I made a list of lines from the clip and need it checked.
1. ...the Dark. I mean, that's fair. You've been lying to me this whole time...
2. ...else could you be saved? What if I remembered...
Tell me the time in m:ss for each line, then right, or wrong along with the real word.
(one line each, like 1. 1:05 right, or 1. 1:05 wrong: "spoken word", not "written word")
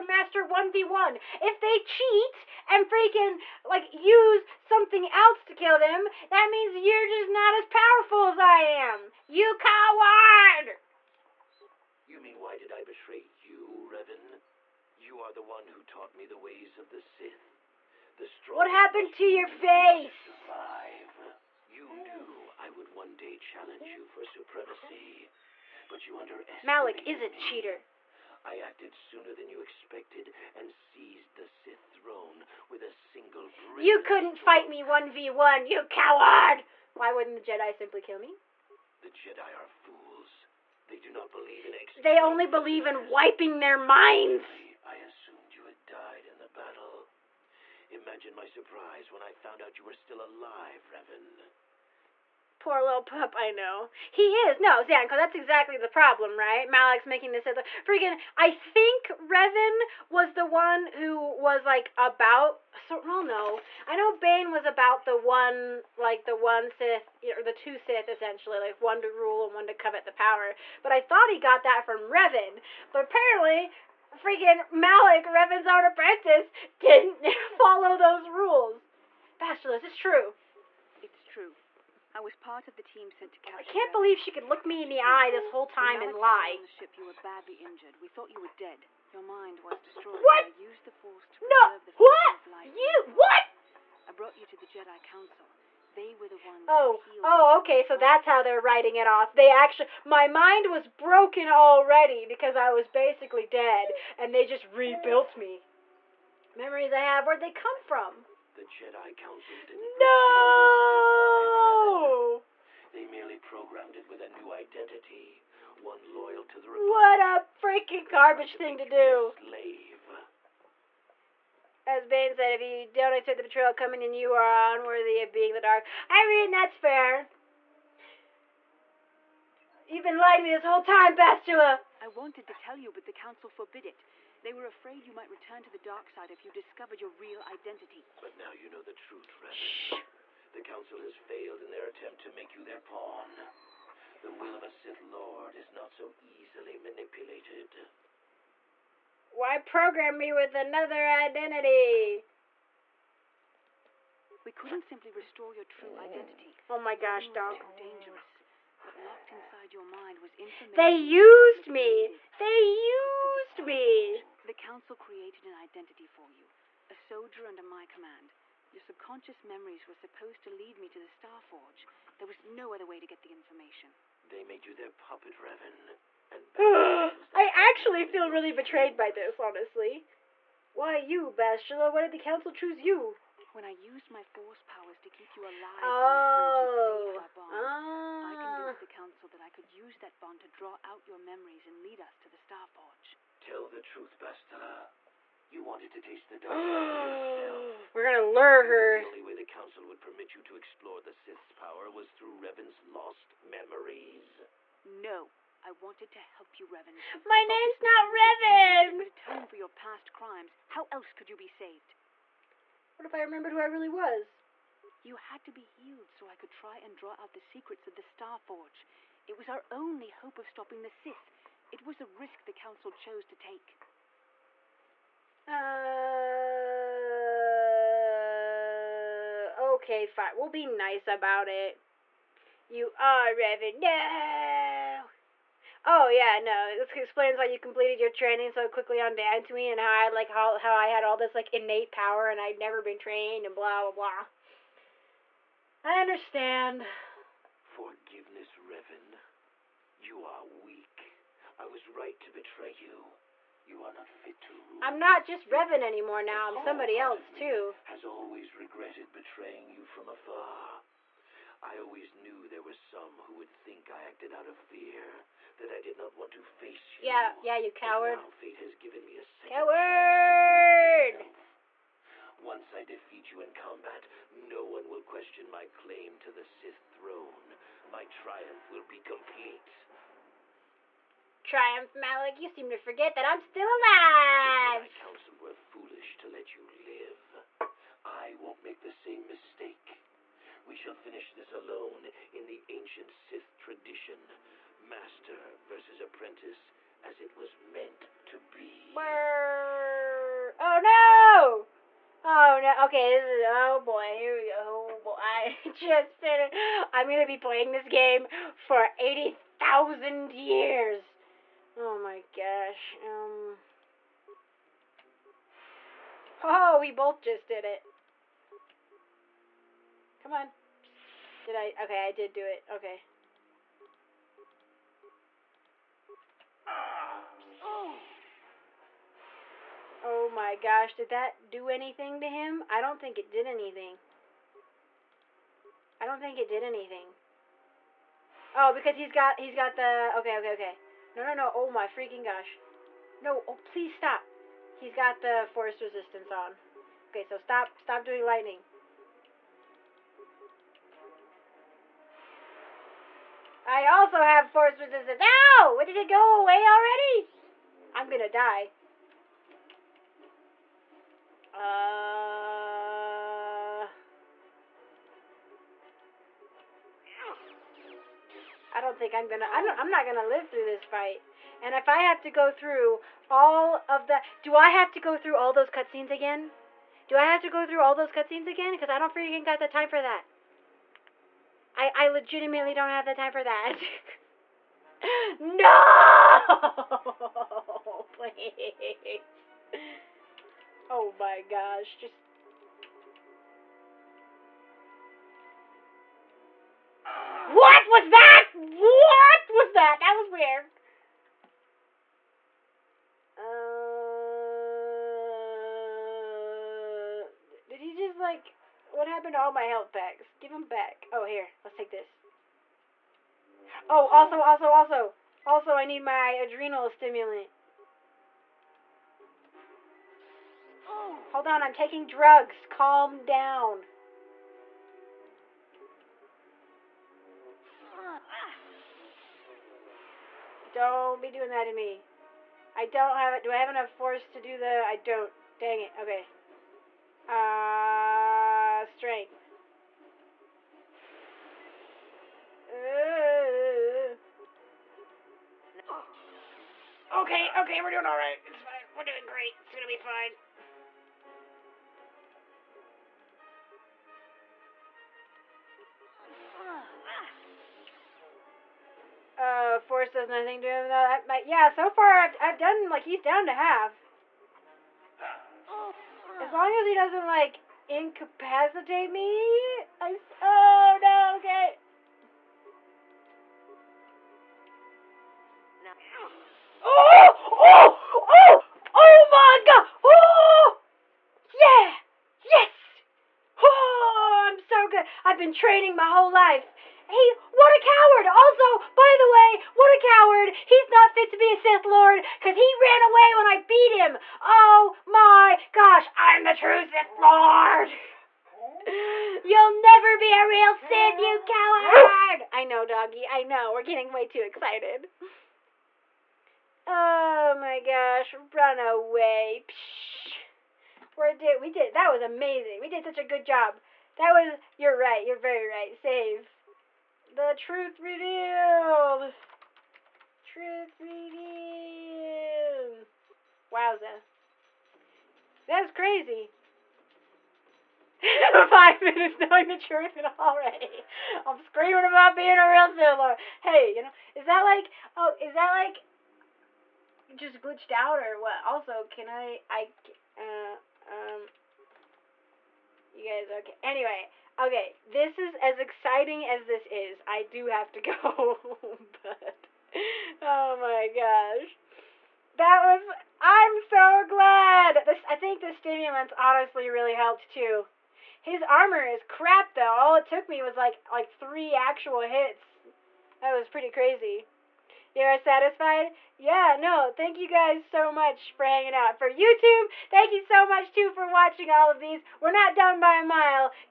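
1. 2:05 right
2. 3:30 right.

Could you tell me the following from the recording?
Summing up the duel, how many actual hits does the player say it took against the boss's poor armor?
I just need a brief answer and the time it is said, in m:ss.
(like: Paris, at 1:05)
3, at 9:21.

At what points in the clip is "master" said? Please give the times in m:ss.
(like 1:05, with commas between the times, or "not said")
0:00, 4:54.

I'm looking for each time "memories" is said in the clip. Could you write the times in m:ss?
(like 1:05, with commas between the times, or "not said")
1:46, 2:49, 3:11, 3:23.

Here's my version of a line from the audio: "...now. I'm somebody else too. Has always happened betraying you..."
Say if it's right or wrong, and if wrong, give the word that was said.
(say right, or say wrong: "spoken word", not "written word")
wrong: "regretted", not "happened".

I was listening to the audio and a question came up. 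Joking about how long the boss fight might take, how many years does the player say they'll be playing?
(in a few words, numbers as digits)
80,000.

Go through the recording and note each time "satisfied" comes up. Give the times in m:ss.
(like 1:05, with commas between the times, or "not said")
9:25.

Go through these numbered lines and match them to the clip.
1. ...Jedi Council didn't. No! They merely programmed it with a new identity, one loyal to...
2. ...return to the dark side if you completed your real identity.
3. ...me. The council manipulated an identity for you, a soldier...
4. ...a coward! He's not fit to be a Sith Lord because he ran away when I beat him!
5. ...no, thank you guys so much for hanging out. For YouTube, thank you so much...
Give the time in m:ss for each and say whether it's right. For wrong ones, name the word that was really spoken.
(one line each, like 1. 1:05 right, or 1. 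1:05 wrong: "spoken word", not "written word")
1. 1:48 right
2. 2:15 wrong: "discovered", not "completed"
3. 2:43 wrong: "created", not "manipulated"
4. 8:09 right
5. 9:26 right.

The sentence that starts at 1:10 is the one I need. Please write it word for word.
But I thought he got that from Revan.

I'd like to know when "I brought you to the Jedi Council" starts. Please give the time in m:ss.
1:34.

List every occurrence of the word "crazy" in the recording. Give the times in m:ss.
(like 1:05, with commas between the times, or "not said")
8:45, 9:23.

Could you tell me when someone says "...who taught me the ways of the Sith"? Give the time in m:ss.
0:15.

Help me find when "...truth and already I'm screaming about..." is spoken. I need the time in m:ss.
8:49.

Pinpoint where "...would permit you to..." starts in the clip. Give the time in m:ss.
3:19.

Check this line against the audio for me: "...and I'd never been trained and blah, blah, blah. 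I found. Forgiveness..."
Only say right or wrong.
wrong.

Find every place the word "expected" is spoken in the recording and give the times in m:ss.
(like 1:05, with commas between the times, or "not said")
0:29.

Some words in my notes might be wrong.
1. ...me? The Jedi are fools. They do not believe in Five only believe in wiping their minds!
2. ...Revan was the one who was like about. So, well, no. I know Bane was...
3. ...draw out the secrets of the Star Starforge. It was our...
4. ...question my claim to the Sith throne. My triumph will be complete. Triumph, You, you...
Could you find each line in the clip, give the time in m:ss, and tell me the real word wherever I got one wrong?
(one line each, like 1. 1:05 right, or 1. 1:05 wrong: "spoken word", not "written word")
1. 0:38 wrong: "They", not "Five"
2. 0:59 right
3. 3:36 wrong: "Forge", not "Starforge"
4. 4:35 wrong: "Malak", not "You".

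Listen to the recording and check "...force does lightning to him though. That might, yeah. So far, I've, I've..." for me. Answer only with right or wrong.
wrong.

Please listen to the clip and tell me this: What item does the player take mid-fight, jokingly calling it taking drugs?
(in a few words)
Adrenal stimulant.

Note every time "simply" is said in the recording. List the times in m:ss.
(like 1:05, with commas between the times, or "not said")
0:37, 2:34.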